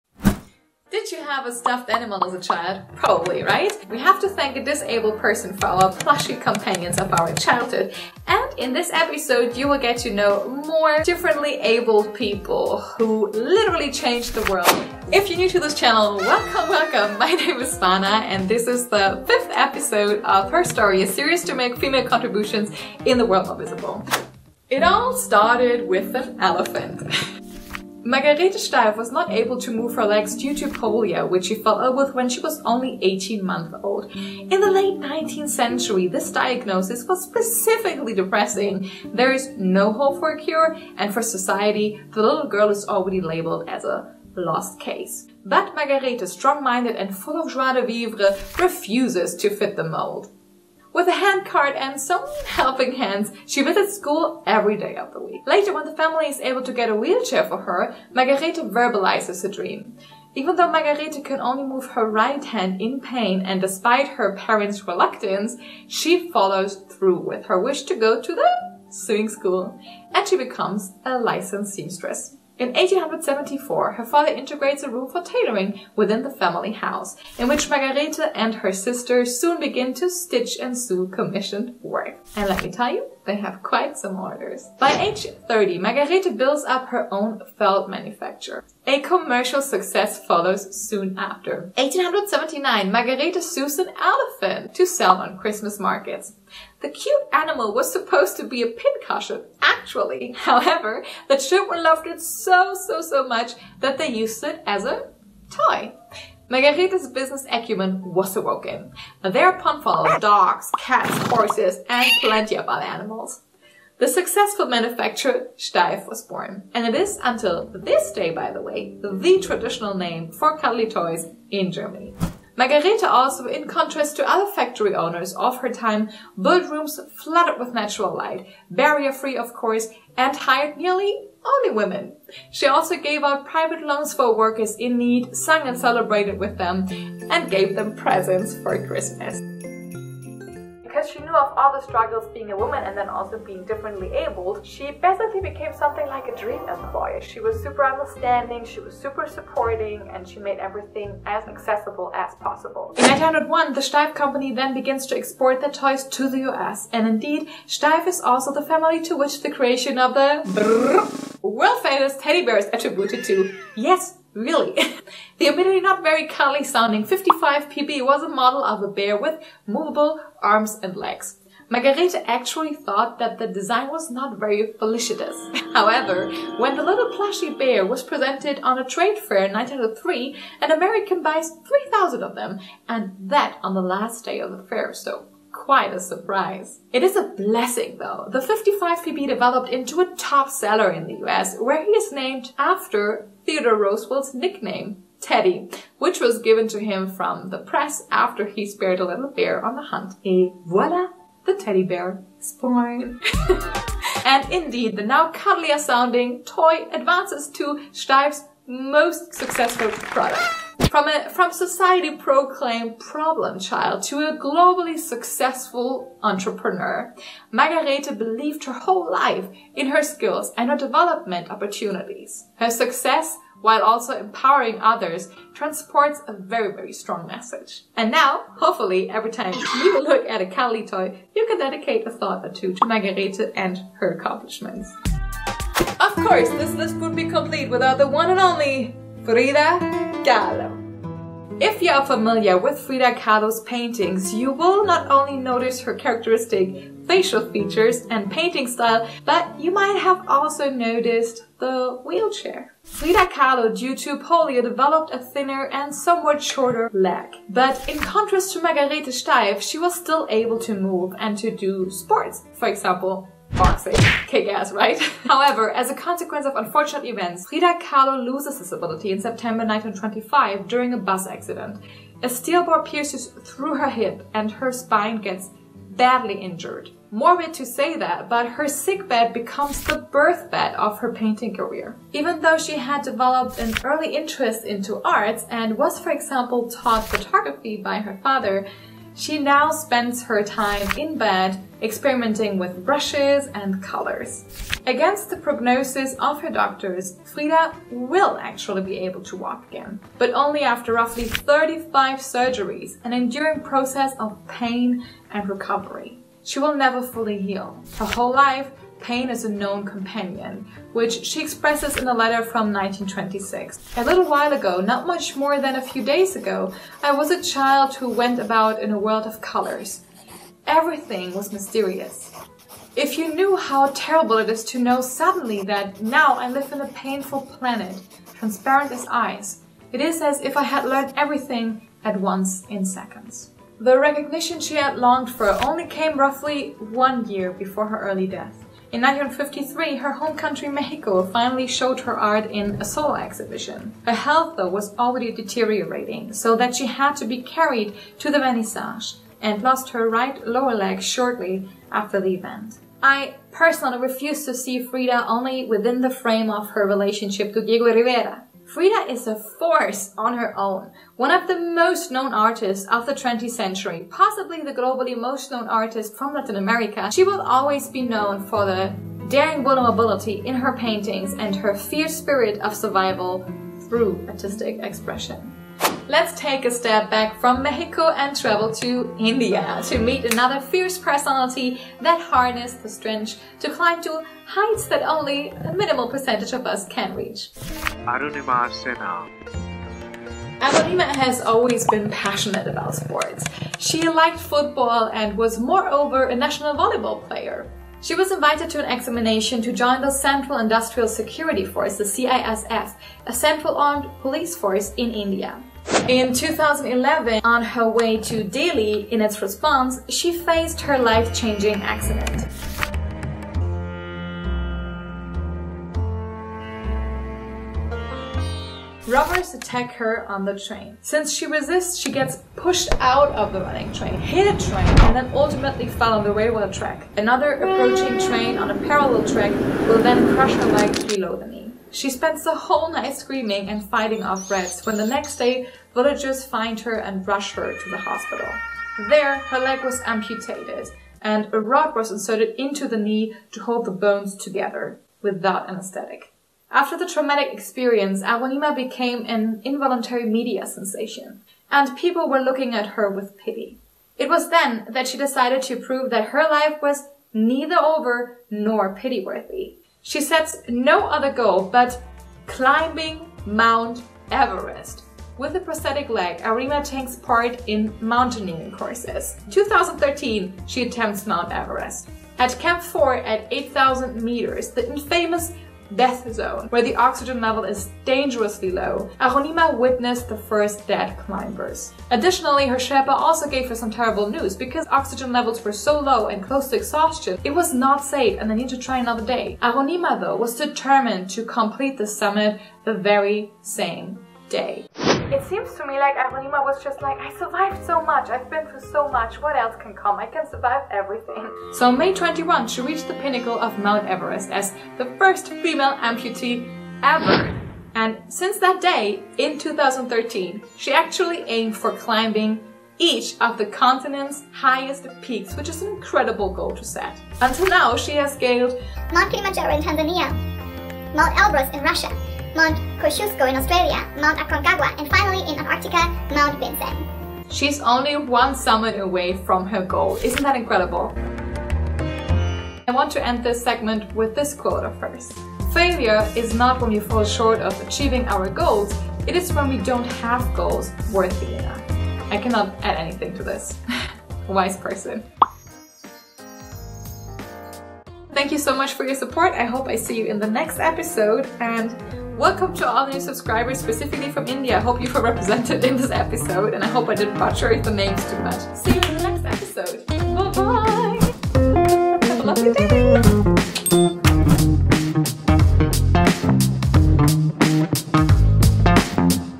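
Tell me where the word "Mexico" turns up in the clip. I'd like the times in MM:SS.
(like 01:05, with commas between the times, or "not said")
05:40, 06:17.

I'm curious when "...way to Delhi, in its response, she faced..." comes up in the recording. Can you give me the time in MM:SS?
06:47.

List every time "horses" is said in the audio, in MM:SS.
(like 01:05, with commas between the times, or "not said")
01:51.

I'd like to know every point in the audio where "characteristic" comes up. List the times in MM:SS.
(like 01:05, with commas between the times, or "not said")
04:05.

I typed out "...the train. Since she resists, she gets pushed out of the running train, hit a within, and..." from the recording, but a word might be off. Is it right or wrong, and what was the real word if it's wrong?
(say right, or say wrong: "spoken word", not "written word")
wrong: "train", not "within".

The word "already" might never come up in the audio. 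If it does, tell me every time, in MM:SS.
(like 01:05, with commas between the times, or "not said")
00:42, 05:44.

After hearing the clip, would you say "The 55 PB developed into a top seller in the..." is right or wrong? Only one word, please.
right.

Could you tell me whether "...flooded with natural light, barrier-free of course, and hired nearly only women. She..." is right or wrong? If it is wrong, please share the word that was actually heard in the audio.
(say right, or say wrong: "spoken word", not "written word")
right.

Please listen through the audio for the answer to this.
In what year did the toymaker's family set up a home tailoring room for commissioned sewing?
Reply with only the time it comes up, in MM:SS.
01:12.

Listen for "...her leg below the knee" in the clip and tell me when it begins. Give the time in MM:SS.
07:10.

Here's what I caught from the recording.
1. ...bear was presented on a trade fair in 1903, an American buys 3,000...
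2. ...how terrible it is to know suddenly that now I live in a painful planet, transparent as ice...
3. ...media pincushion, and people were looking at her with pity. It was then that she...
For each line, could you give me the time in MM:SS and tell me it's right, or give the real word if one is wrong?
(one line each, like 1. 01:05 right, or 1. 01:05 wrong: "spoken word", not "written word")
1. 02:57 right
2. 05:23 right
3. 07:30 wrong: "sensation", not "pincushion".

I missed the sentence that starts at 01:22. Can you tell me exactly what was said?
And let me tell you, they have quite some orders.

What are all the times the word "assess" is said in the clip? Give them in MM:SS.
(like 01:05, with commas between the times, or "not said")
not said.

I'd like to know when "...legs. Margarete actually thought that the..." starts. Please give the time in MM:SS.
02:50.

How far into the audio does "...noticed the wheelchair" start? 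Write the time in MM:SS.
04:10.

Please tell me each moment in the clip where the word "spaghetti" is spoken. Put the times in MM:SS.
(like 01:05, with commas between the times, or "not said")
not said.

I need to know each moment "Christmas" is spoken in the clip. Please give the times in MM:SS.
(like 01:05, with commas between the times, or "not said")
01:35, 02:18.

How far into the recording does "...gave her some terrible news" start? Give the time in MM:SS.
08:03.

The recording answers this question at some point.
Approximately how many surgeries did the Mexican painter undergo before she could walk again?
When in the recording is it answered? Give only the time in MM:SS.
05:01.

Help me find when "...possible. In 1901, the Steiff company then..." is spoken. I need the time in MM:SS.
02:32.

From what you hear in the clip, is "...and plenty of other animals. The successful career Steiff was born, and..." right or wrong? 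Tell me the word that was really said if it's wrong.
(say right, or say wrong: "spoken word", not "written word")
wrong: "manufacturer", not "career".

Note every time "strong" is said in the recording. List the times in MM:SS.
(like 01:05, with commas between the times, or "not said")
00:46, 03:46.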